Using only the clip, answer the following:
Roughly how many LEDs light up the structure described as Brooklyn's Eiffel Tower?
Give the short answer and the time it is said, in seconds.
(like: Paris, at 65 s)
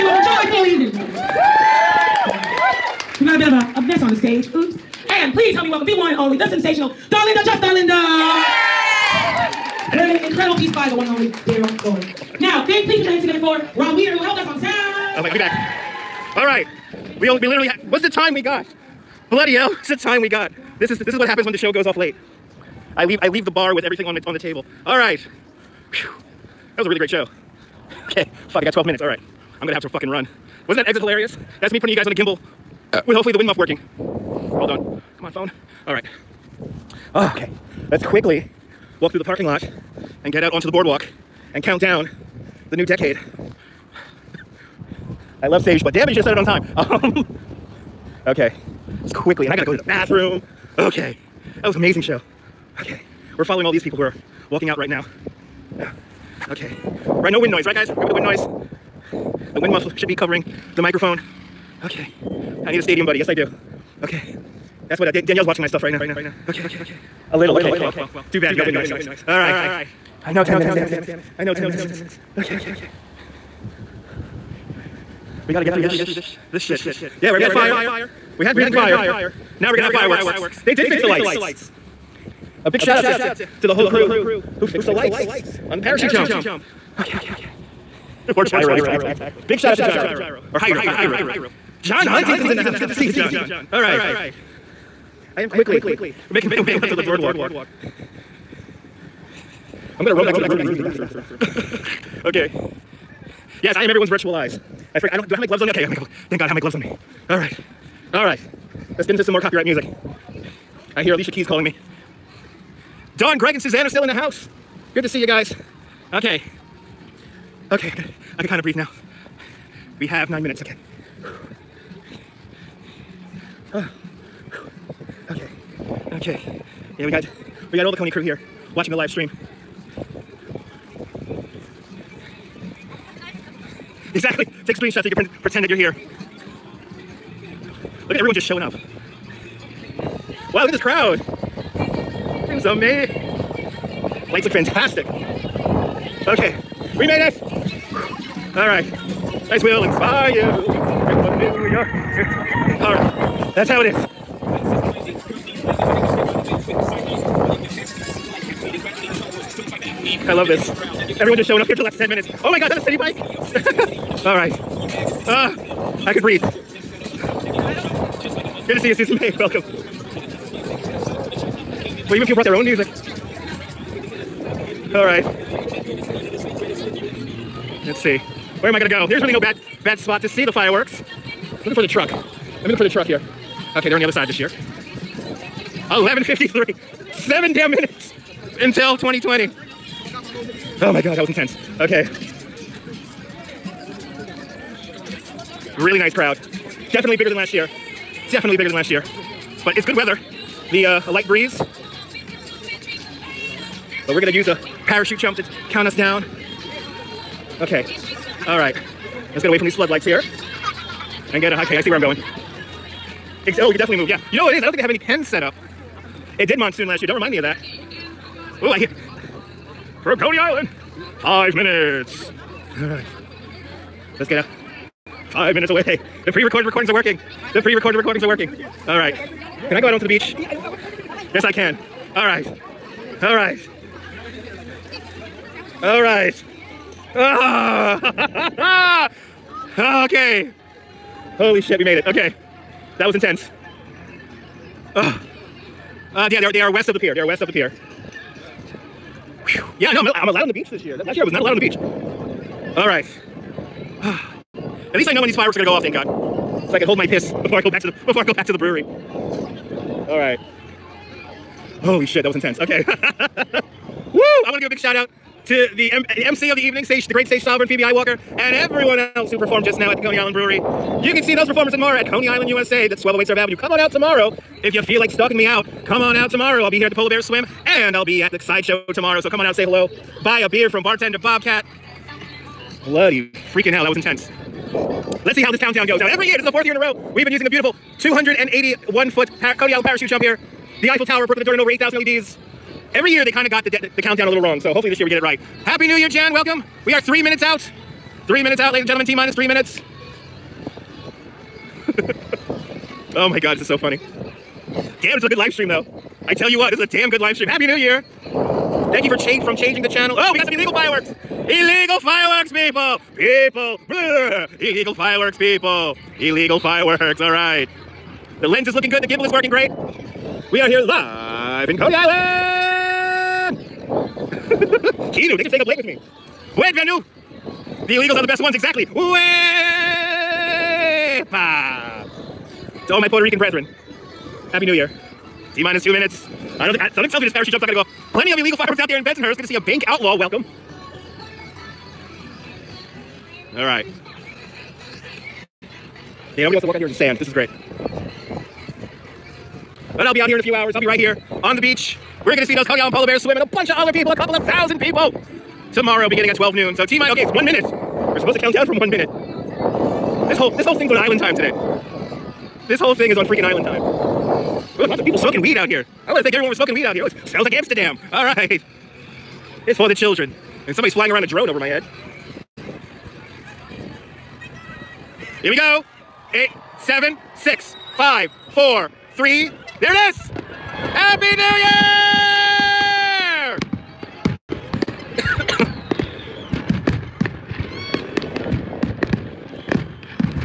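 8,000, at 291 s.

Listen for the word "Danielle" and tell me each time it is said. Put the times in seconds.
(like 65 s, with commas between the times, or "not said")
65 s.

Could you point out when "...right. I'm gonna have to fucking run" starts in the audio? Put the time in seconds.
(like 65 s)
29 s.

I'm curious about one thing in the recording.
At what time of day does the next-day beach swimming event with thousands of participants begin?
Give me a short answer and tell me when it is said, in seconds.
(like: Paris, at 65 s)
12 noon, at 356 s.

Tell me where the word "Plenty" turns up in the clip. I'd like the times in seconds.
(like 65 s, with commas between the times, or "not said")
338 s.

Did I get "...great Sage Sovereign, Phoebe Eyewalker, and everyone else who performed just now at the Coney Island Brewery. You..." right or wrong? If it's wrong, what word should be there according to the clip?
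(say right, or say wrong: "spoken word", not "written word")
right.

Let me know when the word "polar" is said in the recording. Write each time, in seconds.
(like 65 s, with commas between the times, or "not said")
276 s, 352 s.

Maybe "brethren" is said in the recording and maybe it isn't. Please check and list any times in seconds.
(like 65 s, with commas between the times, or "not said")
333 s.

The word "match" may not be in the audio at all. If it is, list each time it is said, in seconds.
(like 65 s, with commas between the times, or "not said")
not said.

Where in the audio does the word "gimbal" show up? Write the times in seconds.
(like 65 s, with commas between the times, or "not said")
32 s, 319 s.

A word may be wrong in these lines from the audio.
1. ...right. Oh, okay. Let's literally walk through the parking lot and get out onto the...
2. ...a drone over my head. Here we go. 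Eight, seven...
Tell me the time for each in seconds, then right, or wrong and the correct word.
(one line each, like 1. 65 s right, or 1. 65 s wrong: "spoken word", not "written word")
1. 35 s wrong: "quickly", not "literally"
2. 371 s right.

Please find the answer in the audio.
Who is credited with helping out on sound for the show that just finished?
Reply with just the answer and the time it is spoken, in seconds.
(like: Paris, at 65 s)
Rob Weeder, at 13 s.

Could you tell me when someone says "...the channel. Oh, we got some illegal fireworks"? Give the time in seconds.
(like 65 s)
309 s.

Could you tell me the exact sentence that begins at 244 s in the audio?
Uh, uh, yeah, they are, they are west of the pier.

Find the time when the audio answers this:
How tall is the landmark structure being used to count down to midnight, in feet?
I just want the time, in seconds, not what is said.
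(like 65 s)
287 s.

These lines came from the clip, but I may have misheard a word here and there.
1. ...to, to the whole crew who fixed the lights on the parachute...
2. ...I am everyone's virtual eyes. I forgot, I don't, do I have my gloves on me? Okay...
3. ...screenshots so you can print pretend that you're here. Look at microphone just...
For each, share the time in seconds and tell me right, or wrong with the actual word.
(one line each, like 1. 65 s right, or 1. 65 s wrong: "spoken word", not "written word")
1. 83 s right
2. 103 s right
3. 134 s wrong: "everyone", not "microphone".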